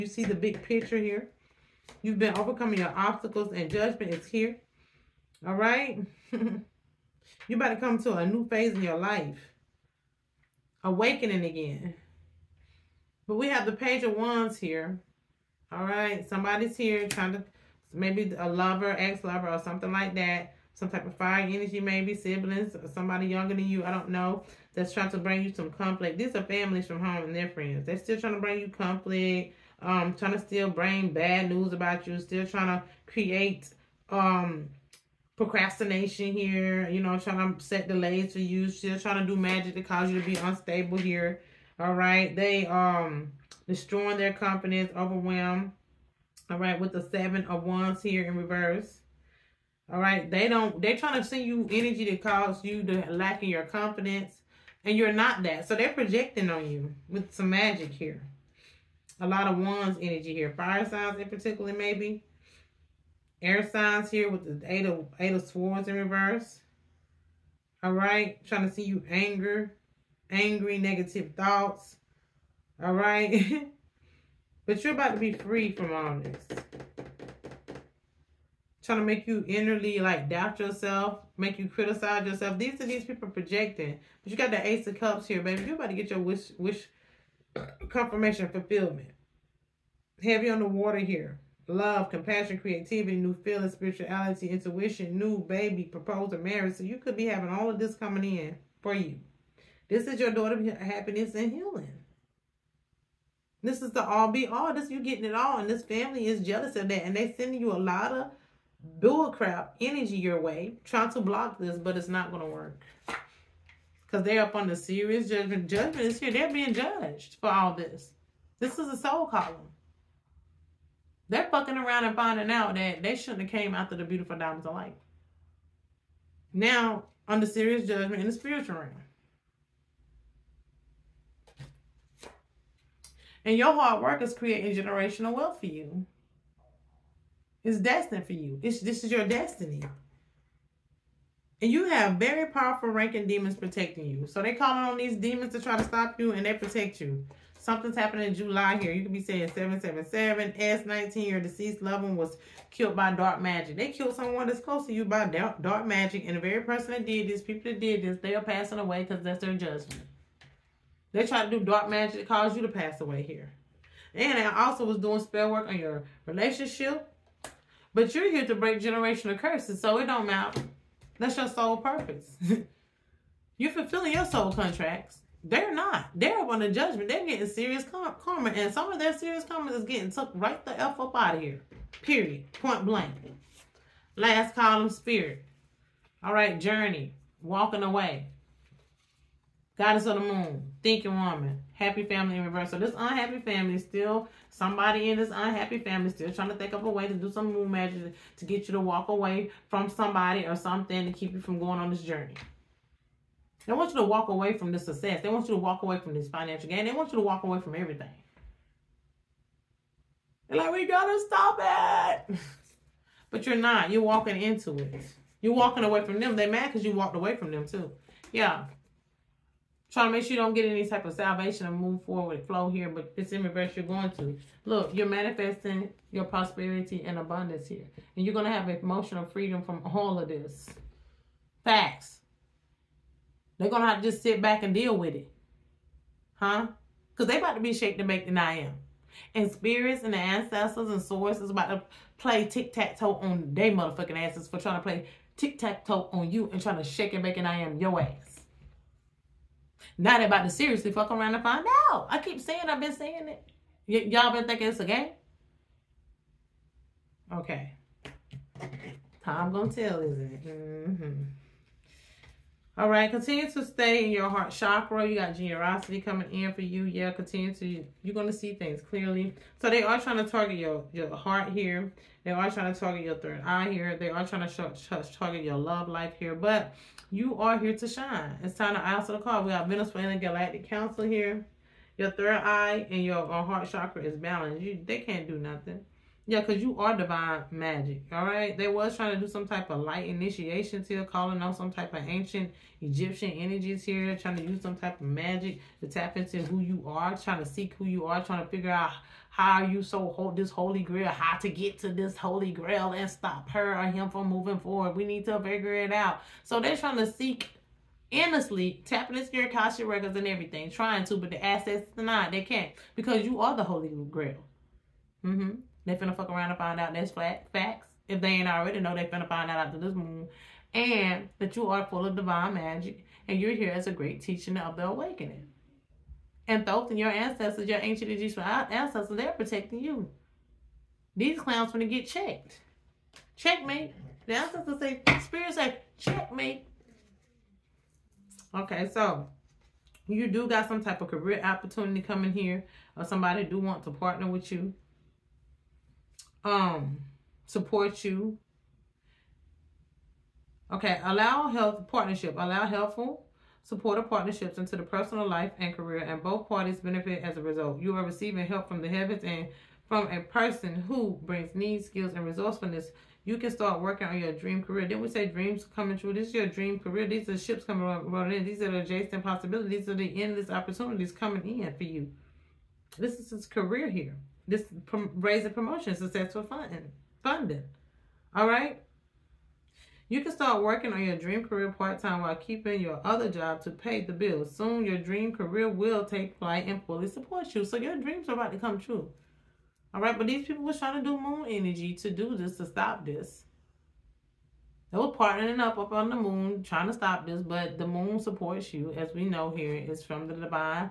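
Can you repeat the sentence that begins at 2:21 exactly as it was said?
And you have very powerful ranking demons protecting you.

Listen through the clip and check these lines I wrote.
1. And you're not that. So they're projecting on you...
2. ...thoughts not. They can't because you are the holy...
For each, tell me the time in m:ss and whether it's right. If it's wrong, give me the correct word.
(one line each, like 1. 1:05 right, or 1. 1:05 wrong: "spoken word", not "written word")
1. 0:54 right
2. 5:11 wrong: "assets", not "thoughts".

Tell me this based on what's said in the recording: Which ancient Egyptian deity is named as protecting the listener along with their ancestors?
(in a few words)
Thoth.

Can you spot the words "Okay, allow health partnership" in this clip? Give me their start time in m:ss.
5:50.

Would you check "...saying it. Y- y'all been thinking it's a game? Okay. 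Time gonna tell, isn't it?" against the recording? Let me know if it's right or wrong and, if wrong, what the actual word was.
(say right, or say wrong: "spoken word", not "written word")
right.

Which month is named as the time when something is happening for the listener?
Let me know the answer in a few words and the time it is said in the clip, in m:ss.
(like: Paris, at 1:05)
July, at 2:28.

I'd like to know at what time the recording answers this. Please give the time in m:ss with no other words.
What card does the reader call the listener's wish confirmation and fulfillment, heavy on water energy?
1:24.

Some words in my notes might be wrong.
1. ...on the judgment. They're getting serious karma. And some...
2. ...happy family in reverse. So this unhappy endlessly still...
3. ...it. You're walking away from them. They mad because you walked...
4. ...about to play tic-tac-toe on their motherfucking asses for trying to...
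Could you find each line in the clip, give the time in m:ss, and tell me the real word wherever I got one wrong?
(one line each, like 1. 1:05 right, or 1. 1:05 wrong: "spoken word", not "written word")
1. 2:56 right
2. 3:11 wrong: "family", not "endlessly"
3. 3:34 right
4. 4:01 right.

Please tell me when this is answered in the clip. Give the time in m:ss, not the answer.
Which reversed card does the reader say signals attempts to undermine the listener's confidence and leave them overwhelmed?
0:47.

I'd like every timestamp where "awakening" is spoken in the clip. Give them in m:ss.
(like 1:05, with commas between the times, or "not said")
0:10, 5:24.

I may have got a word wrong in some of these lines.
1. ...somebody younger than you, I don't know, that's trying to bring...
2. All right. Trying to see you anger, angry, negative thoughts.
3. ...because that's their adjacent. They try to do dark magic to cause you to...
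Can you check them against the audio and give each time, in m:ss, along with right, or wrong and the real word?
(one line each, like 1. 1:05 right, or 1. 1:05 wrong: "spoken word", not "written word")
1. 0:22 right
2. 1:07 right
3. 2:39 wrong: "judgment", not "adjacent".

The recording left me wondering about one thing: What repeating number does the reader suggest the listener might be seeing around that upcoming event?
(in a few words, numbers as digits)
777.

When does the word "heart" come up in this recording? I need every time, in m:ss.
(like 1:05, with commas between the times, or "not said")
4:24, 4:31, 4:43.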